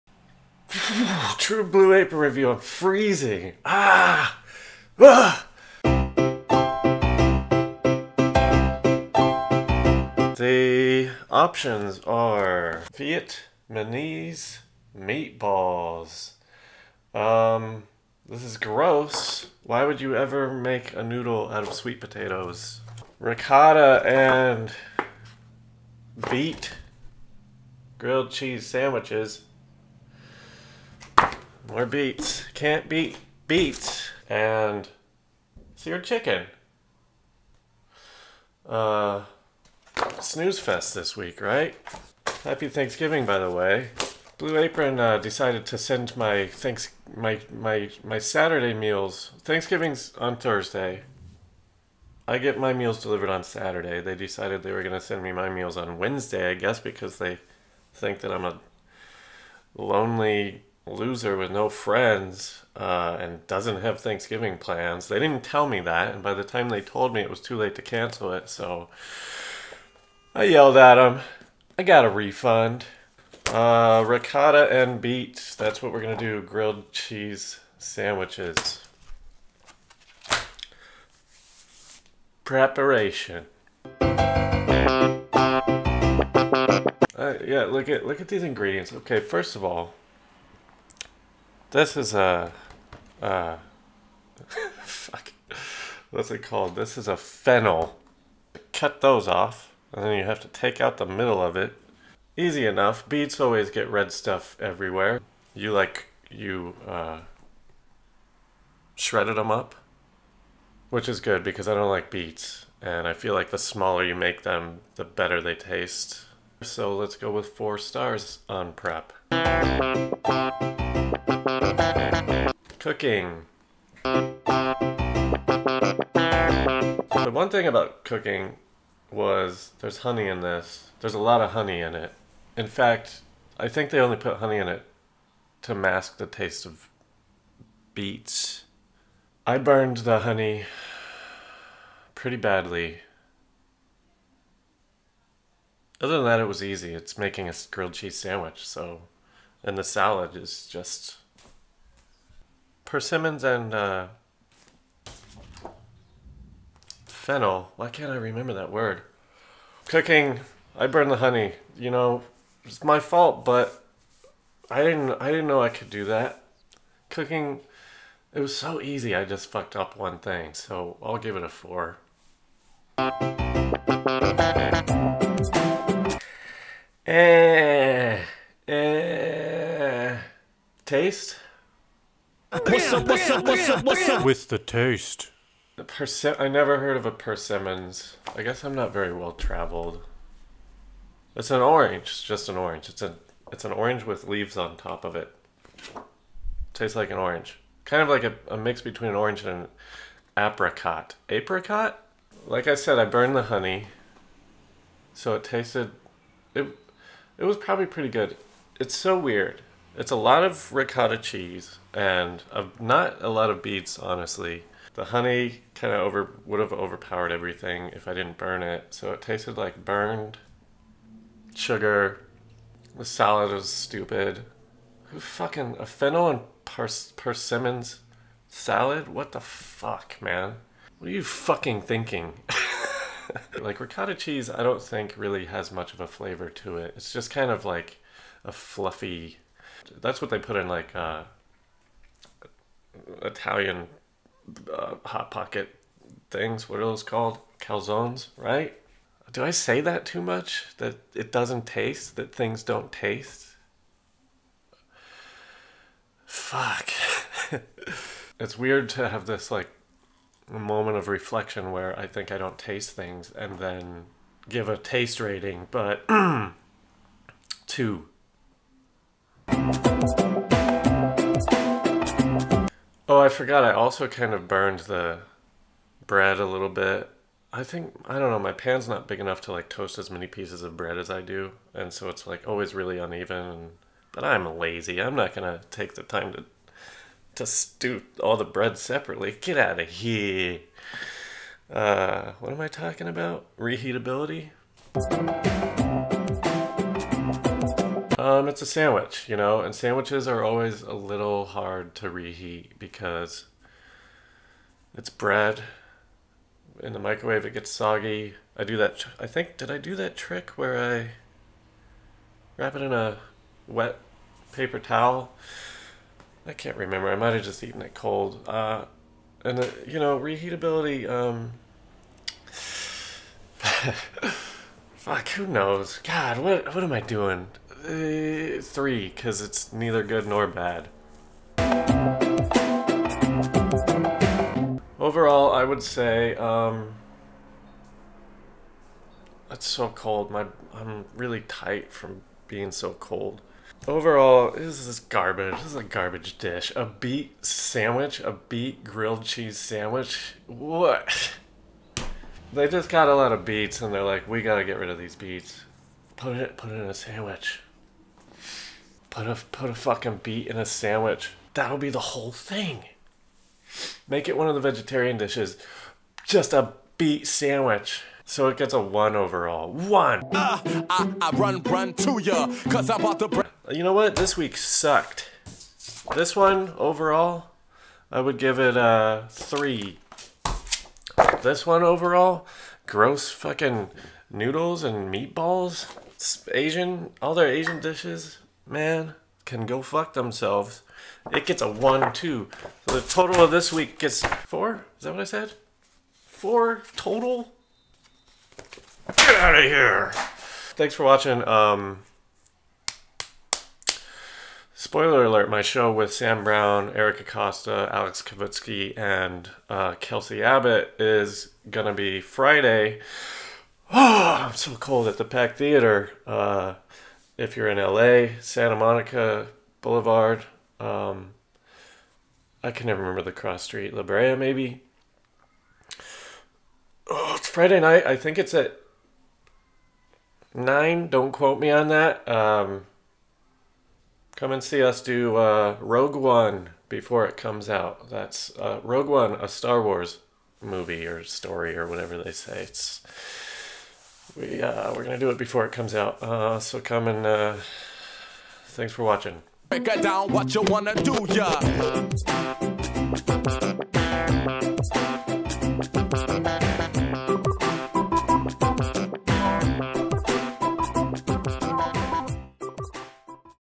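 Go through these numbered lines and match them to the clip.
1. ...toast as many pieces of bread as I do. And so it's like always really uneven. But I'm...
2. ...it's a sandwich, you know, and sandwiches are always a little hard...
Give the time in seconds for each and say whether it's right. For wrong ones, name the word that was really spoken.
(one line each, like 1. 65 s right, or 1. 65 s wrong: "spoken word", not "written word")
1. 279 s right
2. 298 s right.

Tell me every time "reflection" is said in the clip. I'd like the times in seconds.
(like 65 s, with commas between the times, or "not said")
261 s.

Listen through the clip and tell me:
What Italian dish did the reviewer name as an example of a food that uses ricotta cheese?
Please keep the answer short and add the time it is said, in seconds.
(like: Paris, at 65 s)
Calzones, at 247 s.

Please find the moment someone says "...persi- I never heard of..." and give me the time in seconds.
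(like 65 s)
185 s.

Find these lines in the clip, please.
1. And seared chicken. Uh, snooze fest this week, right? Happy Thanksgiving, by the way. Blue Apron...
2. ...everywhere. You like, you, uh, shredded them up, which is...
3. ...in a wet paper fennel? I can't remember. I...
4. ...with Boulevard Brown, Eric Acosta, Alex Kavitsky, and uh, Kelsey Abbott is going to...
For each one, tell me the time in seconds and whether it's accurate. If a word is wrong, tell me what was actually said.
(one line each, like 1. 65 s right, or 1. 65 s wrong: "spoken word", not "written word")
1. 34 s right
2. 104 s right
3. 312 s wrong: "towel", not "fennel"
4. 405 s wrong: "Sam", not "Boulevard".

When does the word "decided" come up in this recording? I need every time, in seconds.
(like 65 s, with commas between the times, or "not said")
45 s, 54 s.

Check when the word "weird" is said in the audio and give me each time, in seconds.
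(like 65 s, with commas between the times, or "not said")
209 s, 258 s.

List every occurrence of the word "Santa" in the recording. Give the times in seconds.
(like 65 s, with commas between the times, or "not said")
418 s.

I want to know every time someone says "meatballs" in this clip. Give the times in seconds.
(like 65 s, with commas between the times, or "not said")
14 s, 385 s.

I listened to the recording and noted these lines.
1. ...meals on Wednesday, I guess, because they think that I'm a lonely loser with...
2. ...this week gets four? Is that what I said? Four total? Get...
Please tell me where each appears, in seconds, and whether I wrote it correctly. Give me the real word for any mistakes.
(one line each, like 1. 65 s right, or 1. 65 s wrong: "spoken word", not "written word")
1. 55 s right
2. 393 s right.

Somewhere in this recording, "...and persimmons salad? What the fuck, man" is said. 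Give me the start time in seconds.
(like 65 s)
226 s.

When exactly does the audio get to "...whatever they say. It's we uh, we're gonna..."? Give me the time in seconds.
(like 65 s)
441 s.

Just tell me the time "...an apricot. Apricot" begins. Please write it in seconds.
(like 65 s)
199 s.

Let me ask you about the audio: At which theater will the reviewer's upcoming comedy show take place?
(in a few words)
Pack Theater.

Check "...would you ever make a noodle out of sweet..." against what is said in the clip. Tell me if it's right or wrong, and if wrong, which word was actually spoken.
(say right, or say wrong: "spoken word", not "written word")
right.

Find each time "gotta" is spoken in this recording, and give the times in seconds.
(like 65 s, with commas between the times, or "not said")
354 s.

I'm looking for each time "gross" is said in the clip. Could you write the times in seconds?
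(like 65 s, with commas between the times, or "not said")
18 s, 382 s.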